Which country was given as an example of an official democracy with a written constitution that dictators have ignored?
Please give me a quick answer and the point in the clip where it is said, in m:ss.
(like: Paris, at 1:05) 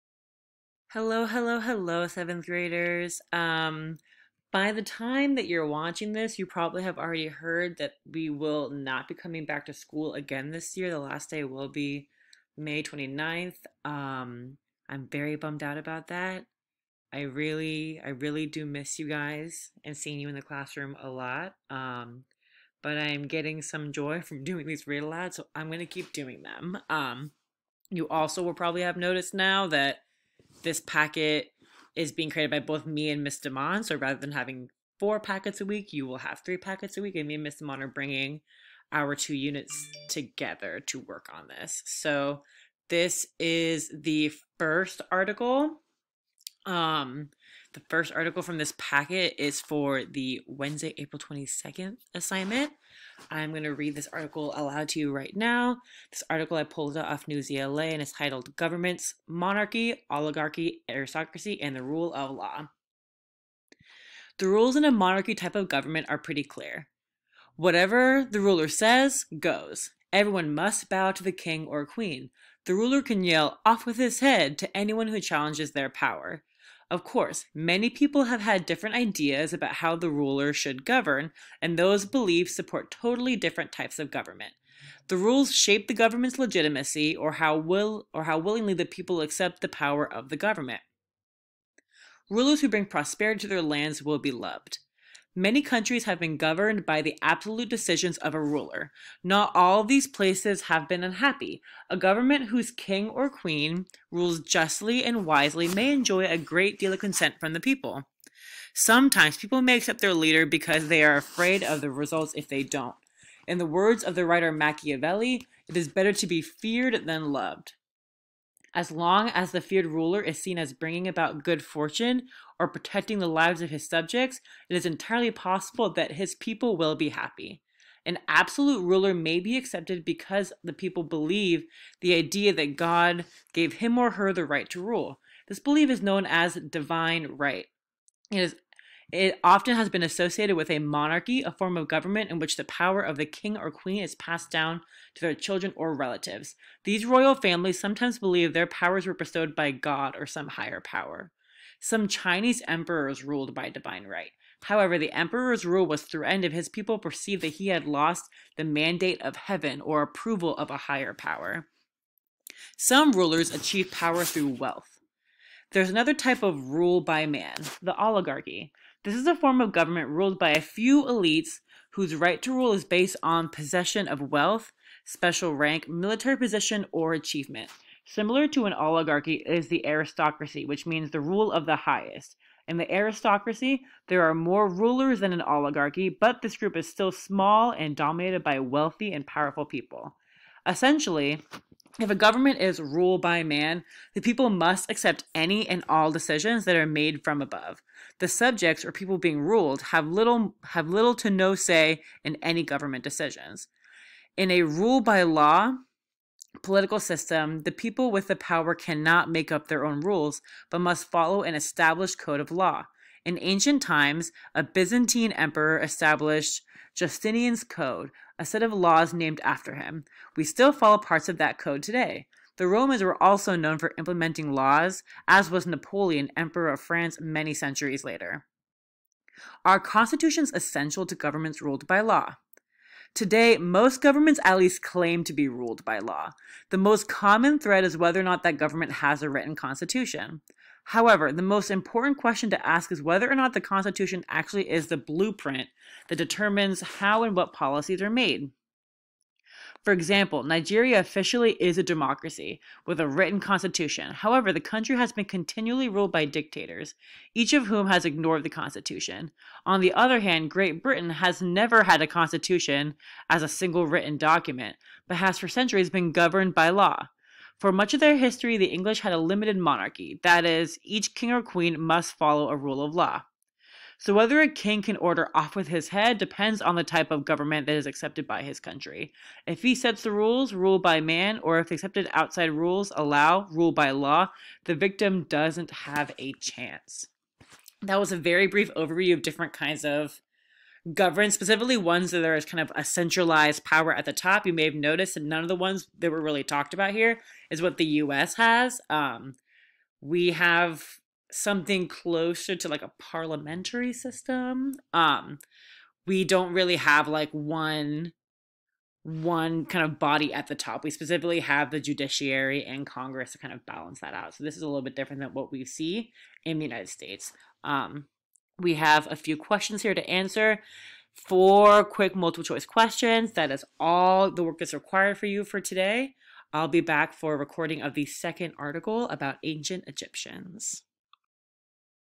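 Nigeria, at 4:10.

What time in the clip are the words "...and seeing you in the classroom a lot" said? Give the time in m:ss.
0:19.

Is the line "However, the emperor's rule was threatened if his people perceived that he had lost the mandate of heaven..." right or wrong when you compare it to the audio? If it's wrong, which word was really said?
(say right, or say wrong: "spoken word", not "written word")
right.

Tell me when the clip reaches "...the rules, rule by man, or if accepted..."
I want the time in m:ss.
4:40.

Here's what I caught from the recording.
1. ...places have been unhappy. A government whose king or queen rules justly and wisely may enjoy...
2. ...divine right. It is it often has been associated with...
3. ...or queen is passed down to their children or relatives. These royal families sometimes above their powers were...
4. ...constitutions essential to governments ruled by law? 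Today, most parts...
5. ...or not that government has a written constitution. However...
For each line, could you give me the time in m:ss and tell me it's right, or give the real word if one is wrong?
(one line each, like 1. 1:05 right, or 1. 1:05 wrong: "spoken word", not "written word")
1. 1:40 right
2. 2:16 right
3. 2:23 wrong: "believe", not "above"
4. 3:49 wrong: "governments", not "parts"
5. 3:58 right.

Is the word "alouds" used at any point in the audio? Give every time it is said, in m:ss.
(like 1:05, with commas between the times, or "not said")
0:25, 0:54.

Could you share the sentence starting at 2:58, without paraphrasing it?
Similar to an oligarchy is the aristocracy, which means the rule of the highest.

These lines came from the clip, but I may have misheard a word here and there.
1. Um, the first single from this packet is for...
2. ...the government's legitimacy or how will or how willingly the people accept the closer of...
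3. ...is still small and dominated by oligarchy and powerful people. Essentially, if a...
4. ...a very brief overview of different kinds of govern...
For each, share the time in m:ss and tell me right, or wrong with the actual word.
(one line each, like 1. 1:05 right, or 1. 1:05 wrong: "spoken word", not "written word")
1. 0:46 wrong: "article", not "single"
2. 1:25 wrong: "power", not "closer"
3. 3:06 wrong: "wealthy", not "oligarchy"
4. 4:48 right.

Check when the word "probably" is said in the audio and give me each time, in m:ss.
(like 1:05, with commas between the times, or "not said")
0:06, 0:28.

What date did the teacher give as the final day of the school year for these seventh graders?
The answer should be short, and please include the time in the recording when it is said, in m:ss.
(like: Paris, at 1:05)
May 29th, at 0:12.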